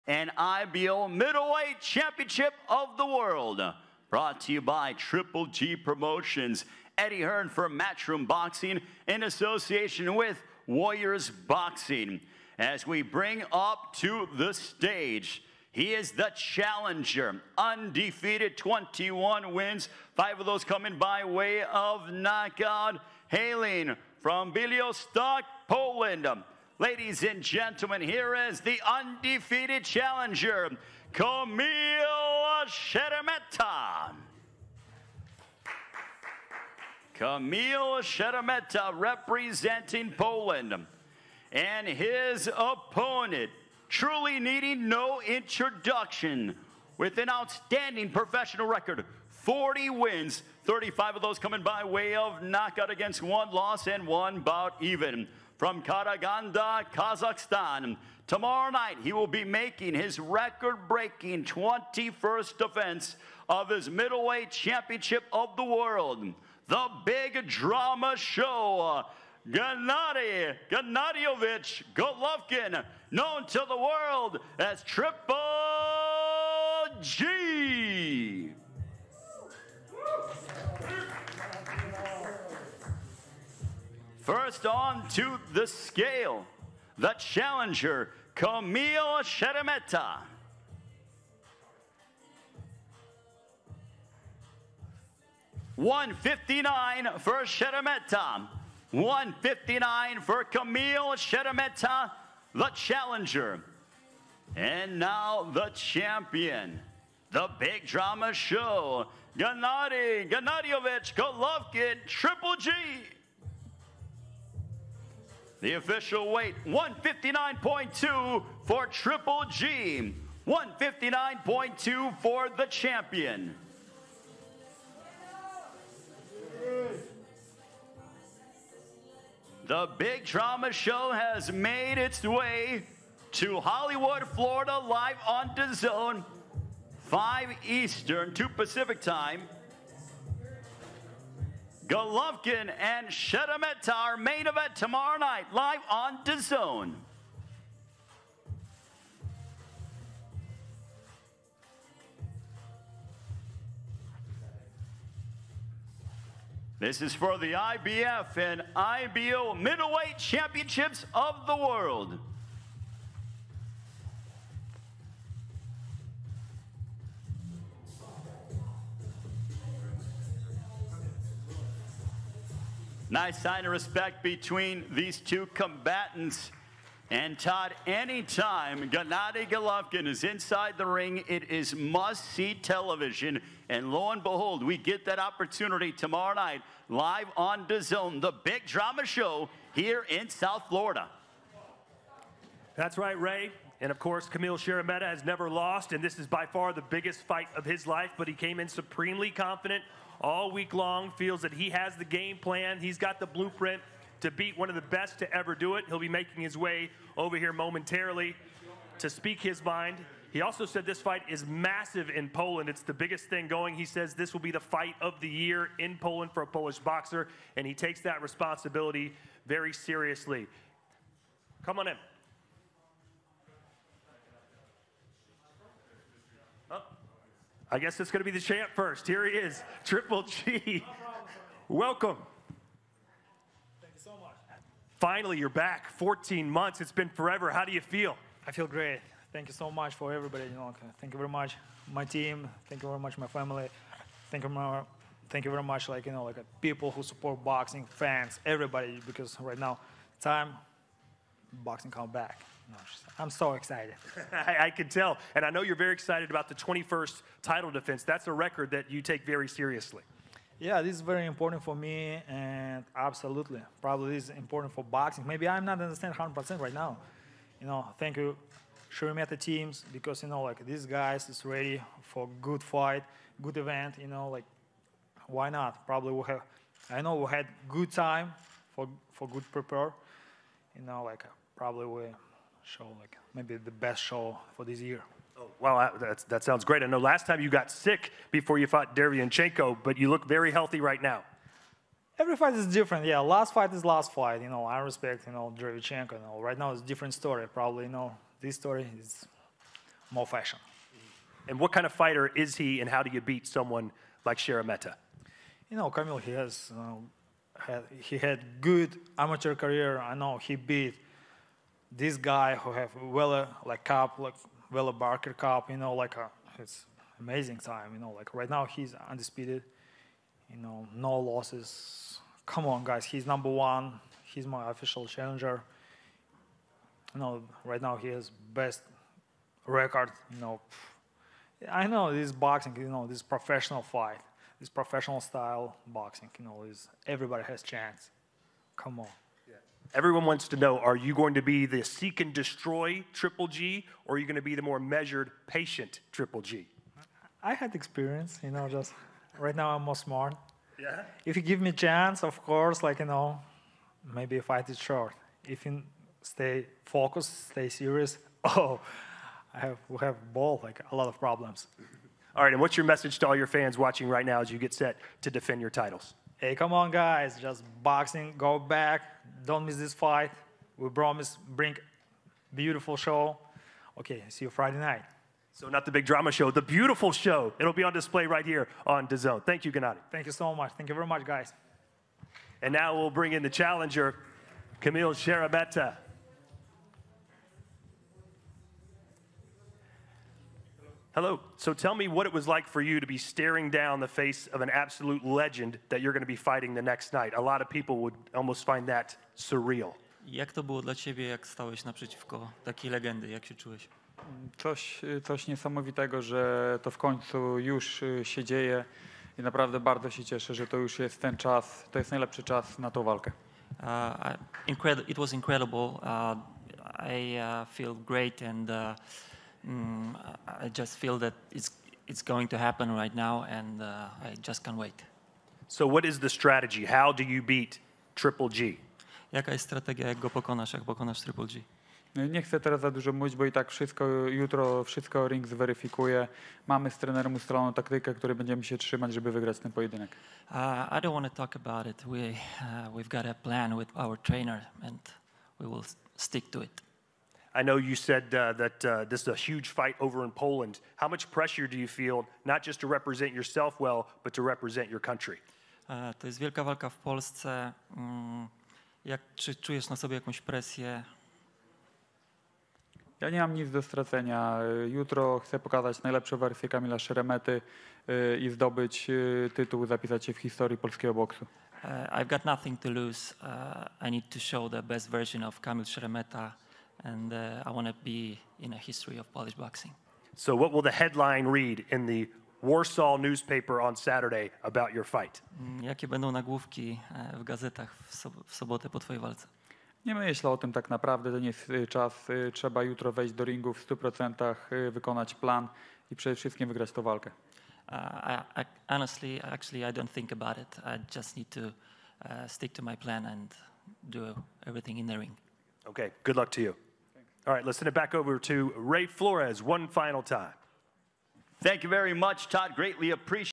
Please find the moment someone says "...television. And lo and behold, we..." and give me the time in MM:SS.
03:02.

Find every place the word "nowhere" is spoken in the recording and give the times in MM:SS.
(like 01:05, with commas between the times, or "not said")
not said.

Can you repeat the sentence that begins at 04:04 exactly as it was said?
Thank you thank you very much, like you know, like people who support boxing, fans, everybody.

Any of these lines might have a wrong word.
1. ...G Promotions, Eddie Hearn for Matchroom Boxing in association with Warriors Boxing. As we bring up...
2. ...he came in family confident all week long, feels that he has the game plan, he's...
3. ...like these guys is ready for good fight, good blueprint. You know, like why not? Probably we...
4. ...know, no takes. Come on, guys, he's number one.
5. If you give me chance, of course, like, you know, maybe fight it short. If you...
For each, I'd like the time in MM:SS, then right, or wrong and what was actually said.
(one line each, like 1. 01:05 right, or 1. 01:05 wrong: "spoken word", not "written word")
1. 00:05 right
2. 03:18 wrong: "supremely", not "family"
3. 04:30 wrong: "event", not "blueprint"
4. 05:20 wrong: "losses", not "takes"
5. 05:51 right.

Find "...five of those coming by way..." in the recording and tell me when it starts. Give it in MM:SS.
00:20.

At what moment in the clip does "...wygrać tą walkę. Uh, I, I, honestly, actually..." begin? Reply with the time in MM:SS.
08:16.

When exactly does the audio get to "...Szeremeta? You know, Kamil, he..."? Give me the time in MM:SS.
05:04.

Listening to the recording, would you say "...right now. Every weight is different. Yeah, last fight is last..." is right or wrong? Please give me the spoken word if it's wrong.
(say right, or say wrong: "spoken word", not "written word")
wrong: "fight", not "weight".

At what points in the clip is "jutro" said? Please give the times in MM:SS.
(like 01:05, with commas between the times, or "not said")
07:14, 07:44, 08:12.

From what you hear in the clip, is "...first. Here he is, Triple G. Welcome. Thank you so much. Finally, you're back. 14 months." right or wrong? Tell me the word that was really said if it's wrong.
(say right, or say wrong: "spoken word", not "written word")
right.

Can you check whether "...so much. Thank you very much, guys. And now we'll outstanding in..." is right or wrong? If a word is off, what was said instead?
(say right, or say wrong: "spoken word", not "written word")
wrong: "bring", not "outstanding".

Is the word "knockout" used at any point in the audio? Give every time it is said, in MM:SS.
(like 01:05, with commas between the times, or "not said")
00:22, 00:52.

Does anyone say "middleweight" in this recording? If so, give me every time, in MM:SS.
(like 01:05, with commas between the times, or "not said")
00:01, 01:03, 02:39.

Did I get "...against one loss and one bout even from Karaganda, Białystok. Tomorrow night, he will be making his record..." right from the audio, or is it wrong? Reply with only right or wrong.
wrong.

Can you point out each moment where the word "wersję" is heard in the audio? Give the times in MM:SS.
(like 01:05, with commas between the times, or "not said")
07:46.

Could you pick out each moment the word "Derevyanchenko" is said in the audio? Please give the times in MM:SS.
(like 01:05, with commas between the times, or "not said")
04:48, 04:55.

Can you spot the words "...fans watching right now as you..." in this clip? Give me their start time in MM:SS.
06:03.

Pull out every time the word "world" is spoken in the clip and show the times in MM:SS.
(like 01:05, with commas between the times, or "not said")
00:03, 01:05, 01:13, 02:41.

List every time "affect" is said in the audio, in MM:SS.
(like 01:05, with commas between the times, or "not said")
not said.